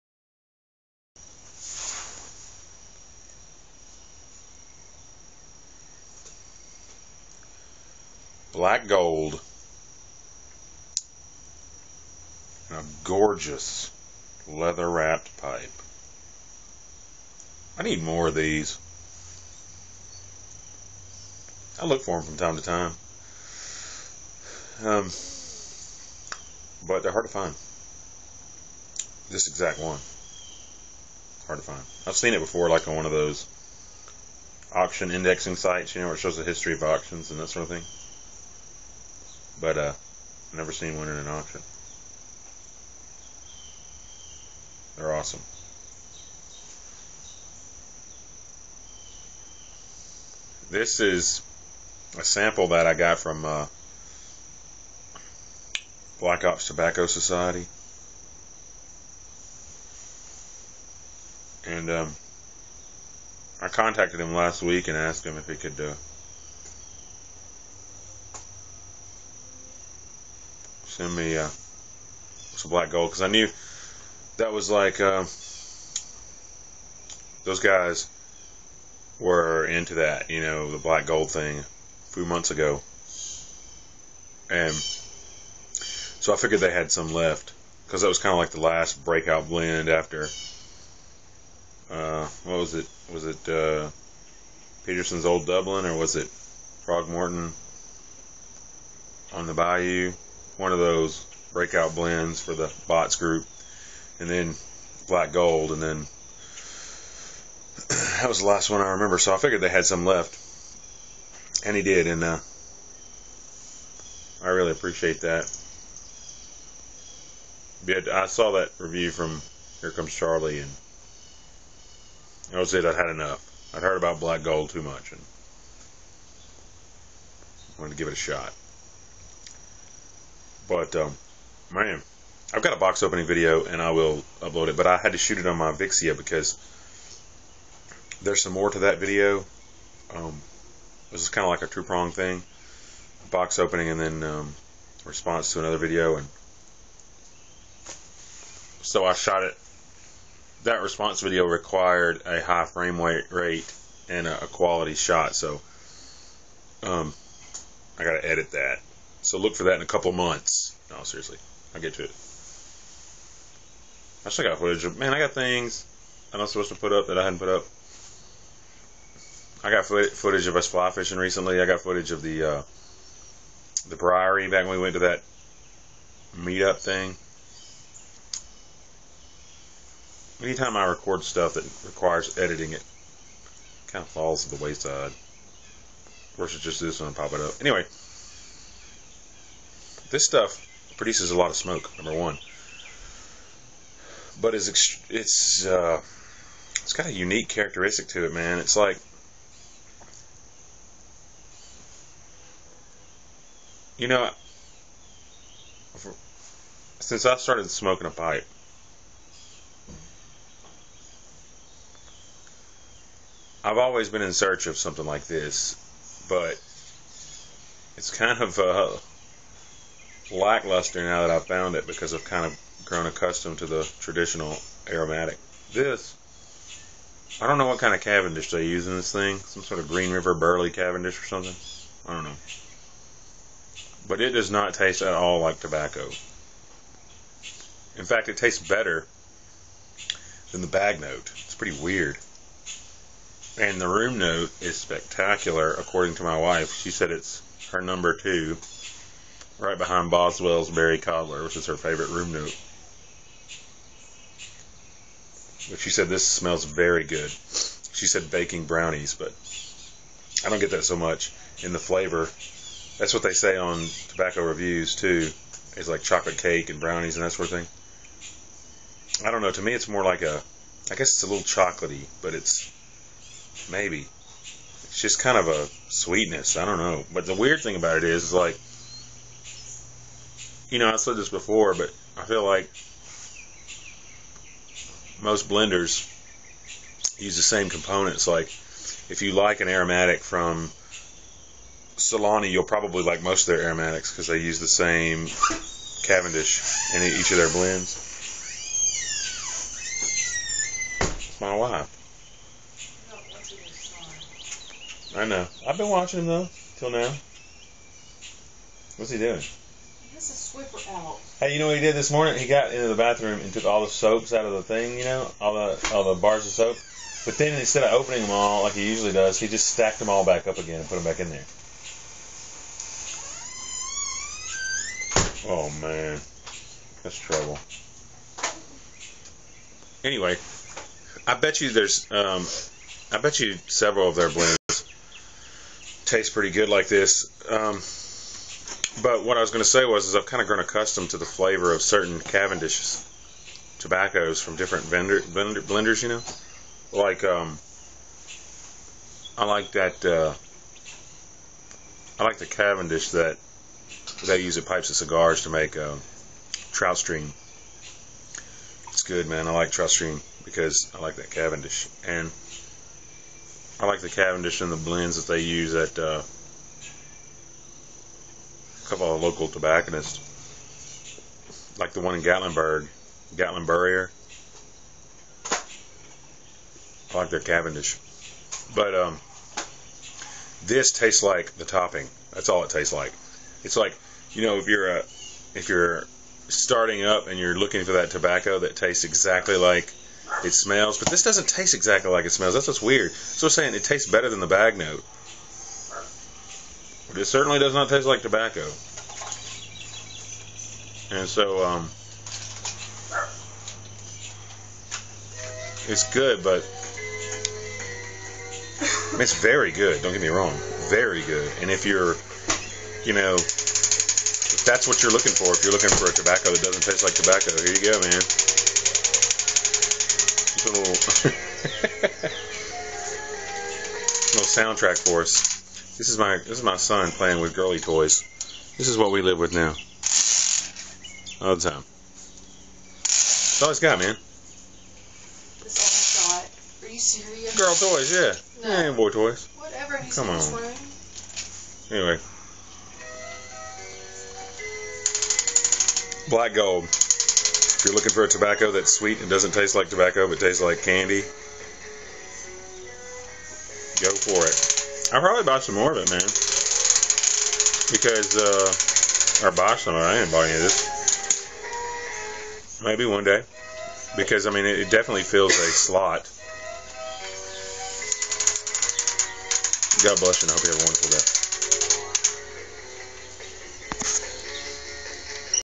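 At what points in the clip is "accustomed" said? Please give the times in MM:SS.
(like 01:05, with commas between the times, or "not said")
03:43, 05:40.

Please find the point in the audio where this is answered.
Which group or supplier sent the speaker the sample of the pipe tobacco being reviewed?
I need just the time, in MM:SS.
00:56.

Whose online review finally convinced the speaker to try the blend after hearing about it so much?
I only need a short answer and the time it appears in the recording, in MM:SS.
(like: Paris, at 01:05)
Here Comes Charlie, at 01:59.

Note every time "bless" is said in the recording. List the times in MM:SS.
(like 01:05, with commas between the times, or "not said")
07:50.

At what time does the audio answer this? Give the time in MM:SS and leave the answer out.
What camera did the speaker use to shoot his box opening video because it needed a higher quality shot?
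02:15.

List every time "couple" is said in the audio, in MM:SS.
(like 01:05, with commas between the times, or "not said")
02:39, 06:08.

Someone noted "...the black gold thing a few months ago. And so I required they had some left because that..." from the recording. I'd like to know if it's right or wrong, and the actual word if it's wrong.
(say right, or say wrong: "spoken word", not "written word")
wrong: "figured", not "required".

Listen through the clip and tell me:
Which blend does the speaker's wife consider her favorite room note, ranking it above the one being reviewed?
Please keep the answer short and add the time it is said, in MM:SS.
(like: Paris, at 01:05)
Boswell's Berry Cobbler, at 04:10.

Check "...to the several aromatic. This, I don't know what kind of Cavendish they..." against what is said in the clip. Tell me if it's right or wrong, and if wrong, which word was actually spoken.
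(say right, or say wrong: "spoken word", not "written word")
wrong: "traditional", not "several".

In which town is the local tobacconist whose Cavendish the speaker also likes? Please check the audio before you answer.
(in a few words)
Gatlinburg.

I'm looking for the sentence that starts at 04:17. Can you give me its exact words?
She said baking brownies, but I don't get that so much in the flavor.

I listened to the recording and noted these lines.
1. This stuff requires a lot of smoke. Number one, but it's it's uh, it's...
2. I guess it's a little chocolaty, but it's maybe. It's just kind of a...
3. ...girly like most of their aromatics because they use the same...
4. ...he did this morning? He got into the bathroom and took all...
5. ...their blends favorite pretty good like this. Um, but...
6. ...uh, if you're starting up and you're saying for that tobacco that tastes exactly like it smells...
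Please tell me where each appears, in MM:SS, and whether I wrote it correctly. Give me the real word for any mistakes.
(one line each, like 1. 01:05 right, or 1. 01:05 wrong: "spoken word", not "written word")
1. 03:10 wrong: "produces", not "requires"
2. 04:30 right
3. 04:52 wrong: "probably", not "girly"
4. 05:11 right
5. 05:34 wrong: "taste", not "favorite"
6. 06:24 wrong: "looking", not "saying".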